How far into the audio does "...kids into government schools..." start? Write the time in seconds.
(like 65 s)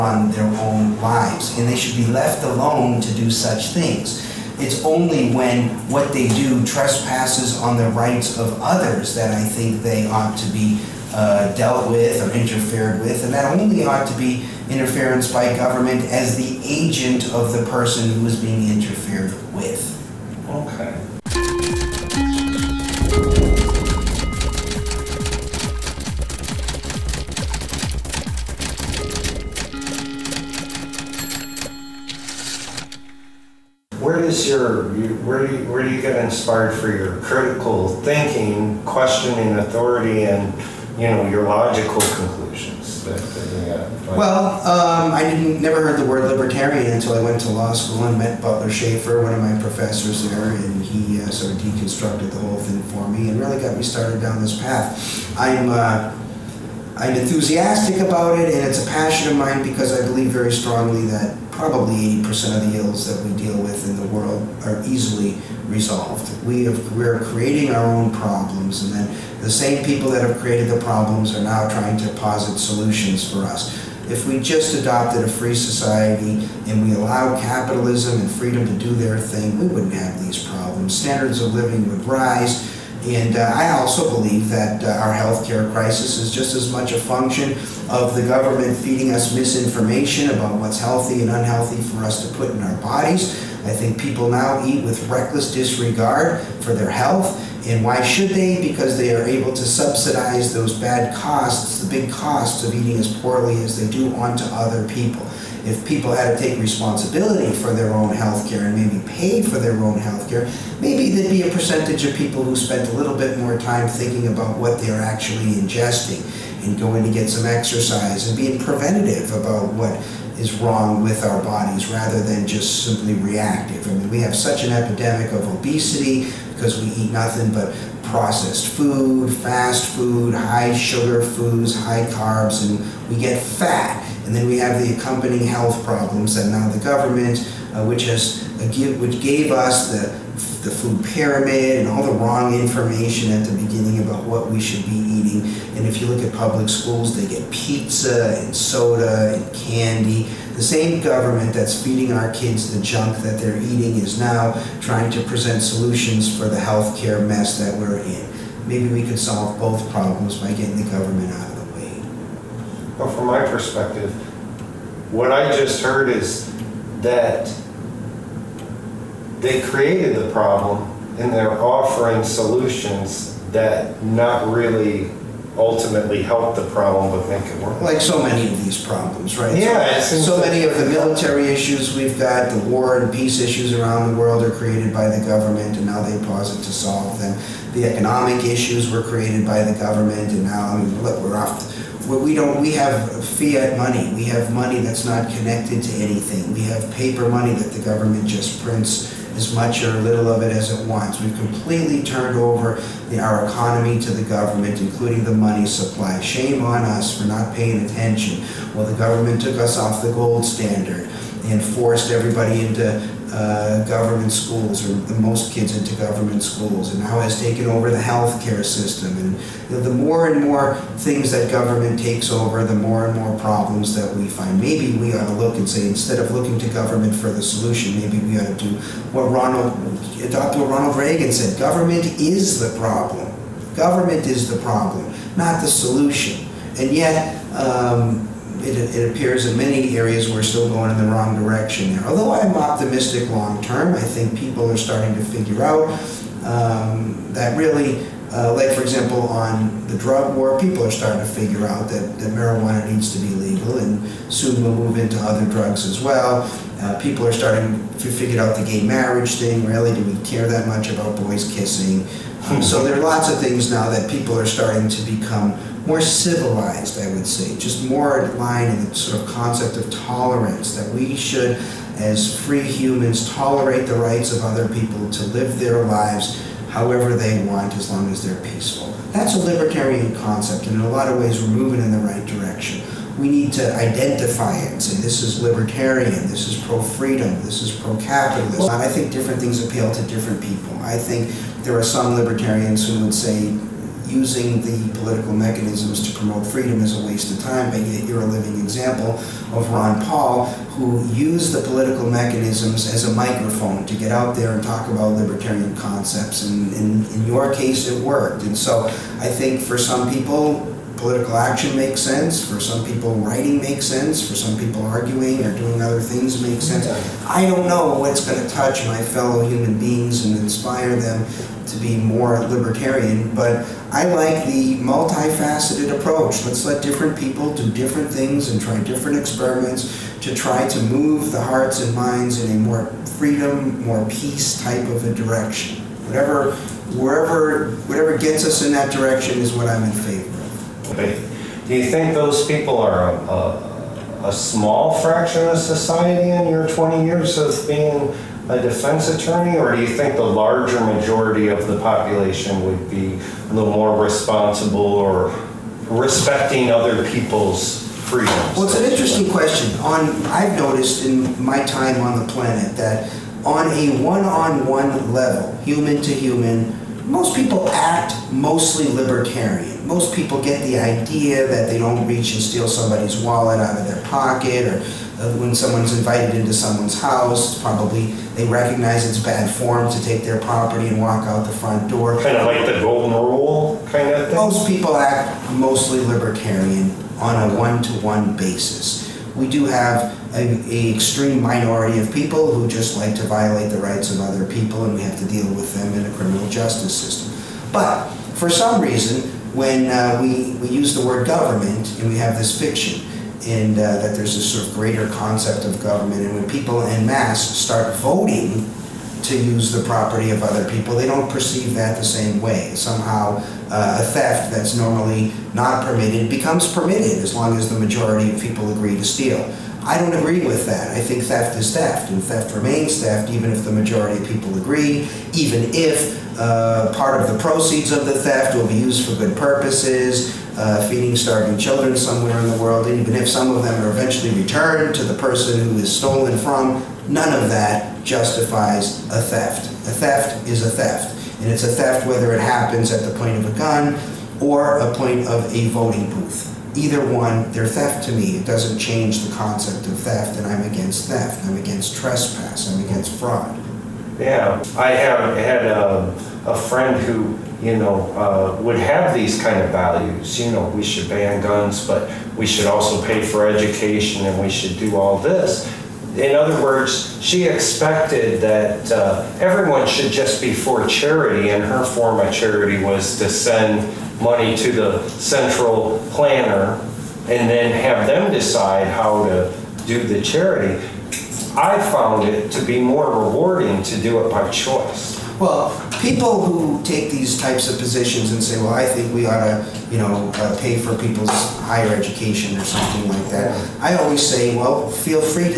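215 s.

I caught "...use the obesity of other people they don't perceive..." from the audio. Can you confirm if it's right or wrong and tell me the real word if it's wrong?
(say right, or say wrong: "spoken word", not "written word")
wrong: "property", not "obesity".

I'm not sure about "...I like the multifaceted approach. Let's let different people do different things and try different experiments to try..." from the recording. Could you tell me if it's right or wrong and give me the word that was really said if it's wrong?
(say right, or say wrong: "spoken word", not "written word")
right.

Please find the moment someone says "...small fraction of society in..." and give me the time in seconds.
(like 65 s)
344 s.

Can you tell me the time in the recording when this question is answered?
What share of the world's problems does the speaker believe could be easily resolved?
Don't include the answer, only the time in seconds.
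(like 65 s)
62 s.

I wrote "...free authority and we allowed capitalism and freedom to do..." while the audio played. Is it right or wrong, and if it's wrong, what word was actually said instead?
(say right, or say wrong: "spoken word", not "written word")
wrong: "society", not "authority".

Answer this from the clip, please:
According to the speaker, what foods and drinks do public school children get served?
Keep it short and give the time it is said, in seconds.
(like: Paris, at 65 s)
pizza and soda and candy, at 147 s.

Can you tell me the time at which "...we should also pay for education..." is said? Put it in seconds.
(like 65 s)
462 s.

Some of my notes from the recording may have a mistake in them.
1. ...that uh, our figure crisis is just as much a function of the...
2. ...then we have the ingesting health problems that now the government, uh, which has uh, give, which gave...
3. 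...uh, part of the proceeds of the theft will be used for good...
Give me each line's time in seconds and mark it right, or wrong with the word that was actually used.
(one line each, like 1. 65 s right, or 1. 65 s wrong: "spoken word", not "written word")
1. 84 s wrong: "healthcare", not "figure"
2. 134 s wrong: "accompanying", not "ingesting"
3. 426 s right.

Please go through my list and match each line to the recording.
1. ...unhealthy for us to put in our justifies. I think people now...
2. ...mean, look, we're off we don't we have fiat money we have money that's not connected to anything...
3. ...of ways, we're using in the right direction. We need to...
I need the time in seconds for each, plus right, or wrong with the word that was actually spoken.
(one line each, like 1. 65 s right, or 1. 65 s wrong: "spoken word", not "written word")
1. 91 s wrong: "bodies", not "justifies"
2. 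190 s right
3. 281 s wrong: "moving", not "using".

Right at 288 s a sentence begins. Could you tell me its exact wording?
I think different things appeal to different people.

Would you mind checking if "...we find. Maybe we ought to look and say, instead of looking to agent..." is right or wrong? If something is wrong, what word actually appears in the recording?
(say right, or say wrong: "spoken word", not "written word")
wrong: "government", not "agent".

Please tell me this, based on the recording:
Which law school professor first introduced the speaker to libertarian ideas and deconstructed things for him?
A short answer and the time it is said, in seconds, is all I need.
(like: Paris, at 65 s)
Butler Shaffer, at 48 s.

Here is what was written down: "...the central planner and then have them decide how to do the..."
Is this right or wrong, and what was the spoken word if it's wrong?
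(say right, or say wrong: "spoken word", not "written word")
right.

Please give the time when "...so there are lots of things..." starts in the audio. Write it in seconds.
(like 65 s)
262 s.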